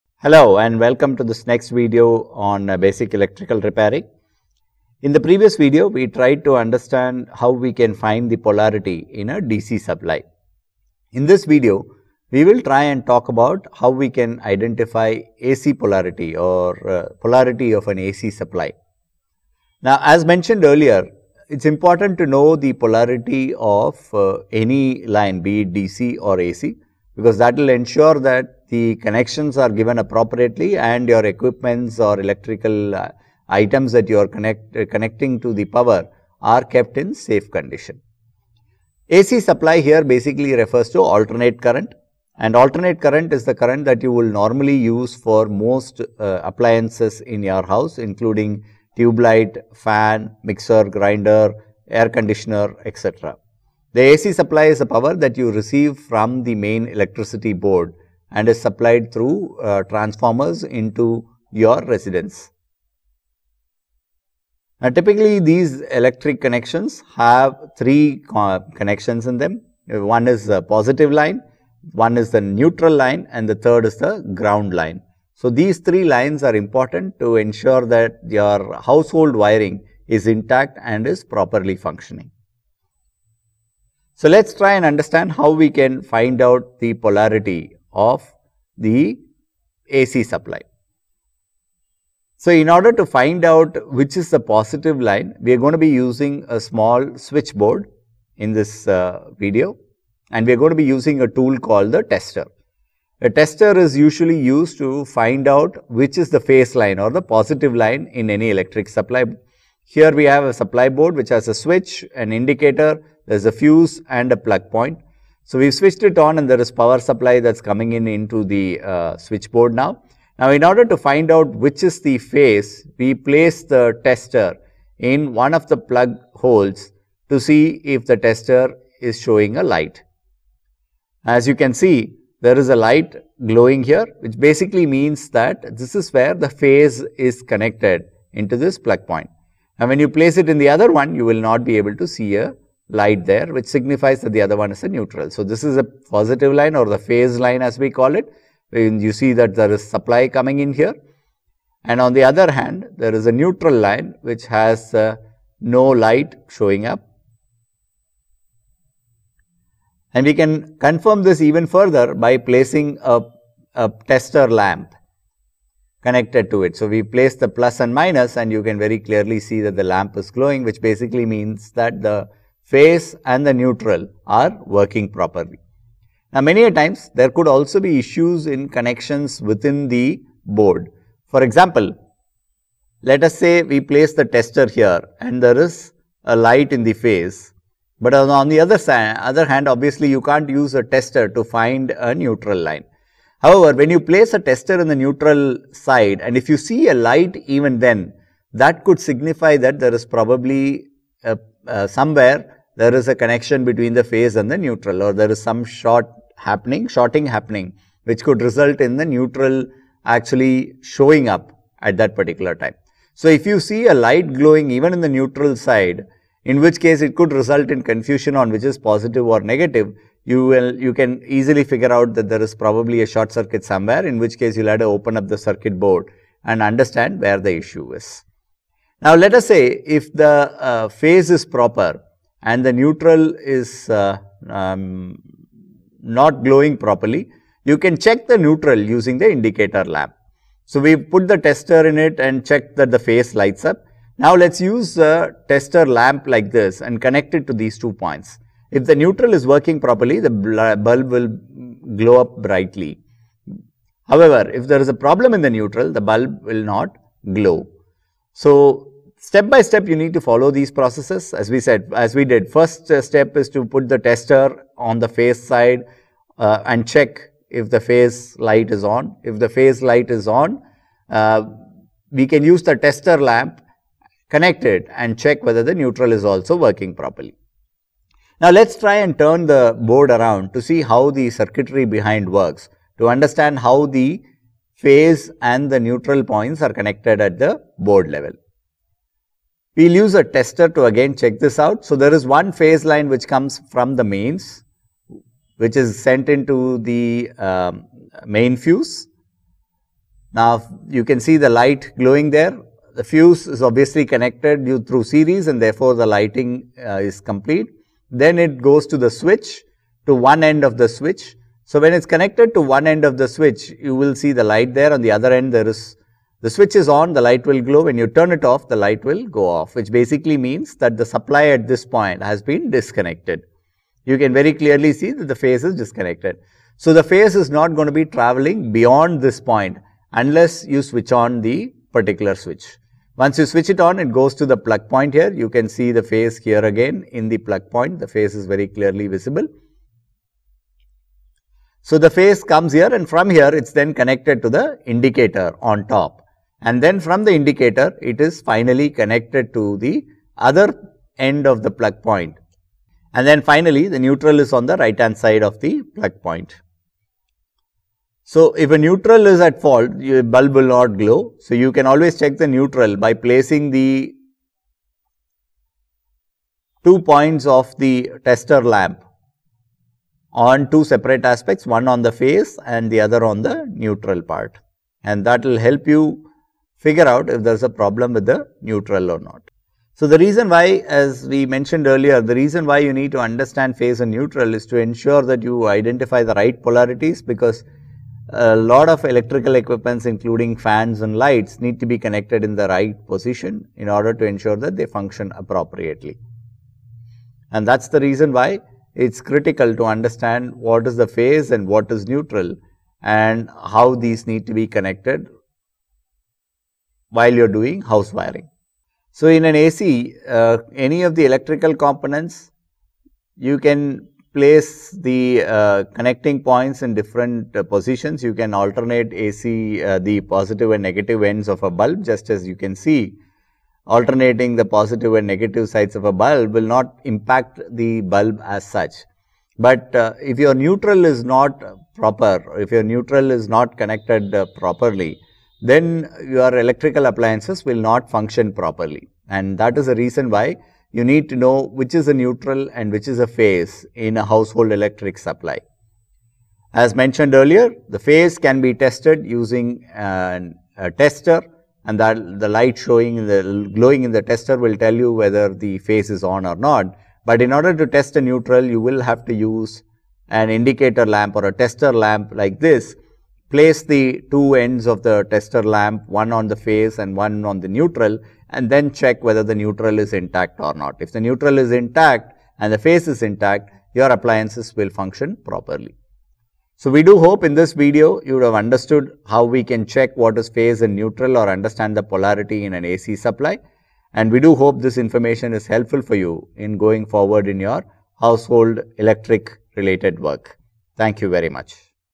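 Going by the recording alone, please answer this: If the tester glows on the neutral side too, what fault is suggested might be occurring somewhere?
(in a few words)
short circuit.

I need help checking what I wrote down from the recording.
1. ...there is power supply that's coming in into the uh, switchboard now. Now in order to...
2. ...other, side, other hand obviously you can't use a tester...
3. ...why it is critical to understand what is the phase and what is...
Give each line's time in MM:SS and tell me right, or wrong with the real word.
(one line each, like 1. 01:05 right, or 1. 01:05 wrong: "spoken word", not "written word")
1. 01:56 right
2. 03:08 right
3. 06:38 right.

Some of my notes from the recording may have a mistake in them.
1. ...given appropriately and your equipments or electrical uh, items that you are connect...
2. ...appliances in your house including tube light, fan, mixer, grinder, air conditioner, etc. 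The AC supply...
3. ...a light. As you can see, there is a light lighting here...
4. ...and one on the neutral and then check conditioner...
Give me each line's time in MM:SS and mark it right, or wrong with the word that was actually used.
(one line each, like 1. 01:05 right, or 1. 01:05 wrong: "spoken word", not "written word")
1. 00:29 right
2. 00:46 right
3. 02:09 wrong: "glowing", not "lighting"
4. 07:46 wrong: "whether", not "conditioner".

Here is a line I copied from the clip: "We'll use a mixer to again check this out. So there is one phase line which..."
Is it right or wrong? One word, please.
wrong.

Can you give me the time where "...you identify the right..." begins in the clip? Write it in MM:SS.
06:25.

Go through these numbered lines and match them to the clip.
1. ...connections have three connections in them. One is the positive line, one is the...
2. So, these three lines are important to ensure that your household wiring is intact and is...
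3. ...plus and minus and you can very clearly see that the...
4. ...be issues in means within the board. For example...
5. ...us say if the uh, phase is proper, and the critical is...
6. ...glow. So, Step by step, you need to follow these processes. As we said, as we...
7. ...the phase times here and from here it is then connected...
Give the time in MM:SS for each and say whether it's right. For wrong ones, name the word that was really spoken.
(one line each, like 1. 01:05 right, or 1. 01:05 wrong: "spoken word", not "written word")
1. 01:06 right
2. 01:15 right
3. 02:47 right
4. 02:57 wrong: "connections", not "means"
5. 03:49 wrong: "neutral", not "critical"
6. 04:17 right
7. 05:41 wrong: "comes", not "times".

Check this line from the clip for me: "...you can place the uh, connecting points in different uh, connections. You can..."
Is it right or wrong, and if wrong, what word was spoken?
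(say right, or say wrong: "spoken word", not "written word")
wrong: "positions", not "connections".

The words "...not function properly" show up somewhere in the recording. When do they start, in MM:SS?
07:17.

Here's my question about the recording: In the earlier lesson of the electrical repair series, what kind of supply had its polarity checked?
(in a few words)
DC supply.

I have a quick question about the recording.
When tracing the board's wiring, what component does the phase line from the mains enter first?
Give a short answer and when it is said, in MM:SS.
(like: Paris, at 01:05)
main fuse, at 04:58.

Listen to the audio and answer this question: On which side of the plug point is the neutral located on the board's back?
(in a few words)
right hand side.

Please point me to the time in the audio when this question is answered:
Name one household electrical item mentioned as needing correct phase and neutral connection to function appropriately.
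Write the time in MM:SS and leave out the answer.
06:30.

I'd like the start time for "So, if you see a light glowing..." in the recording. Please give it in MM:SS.
03:33.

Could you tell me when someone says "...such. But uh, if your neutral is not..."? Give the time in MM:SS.
07:08.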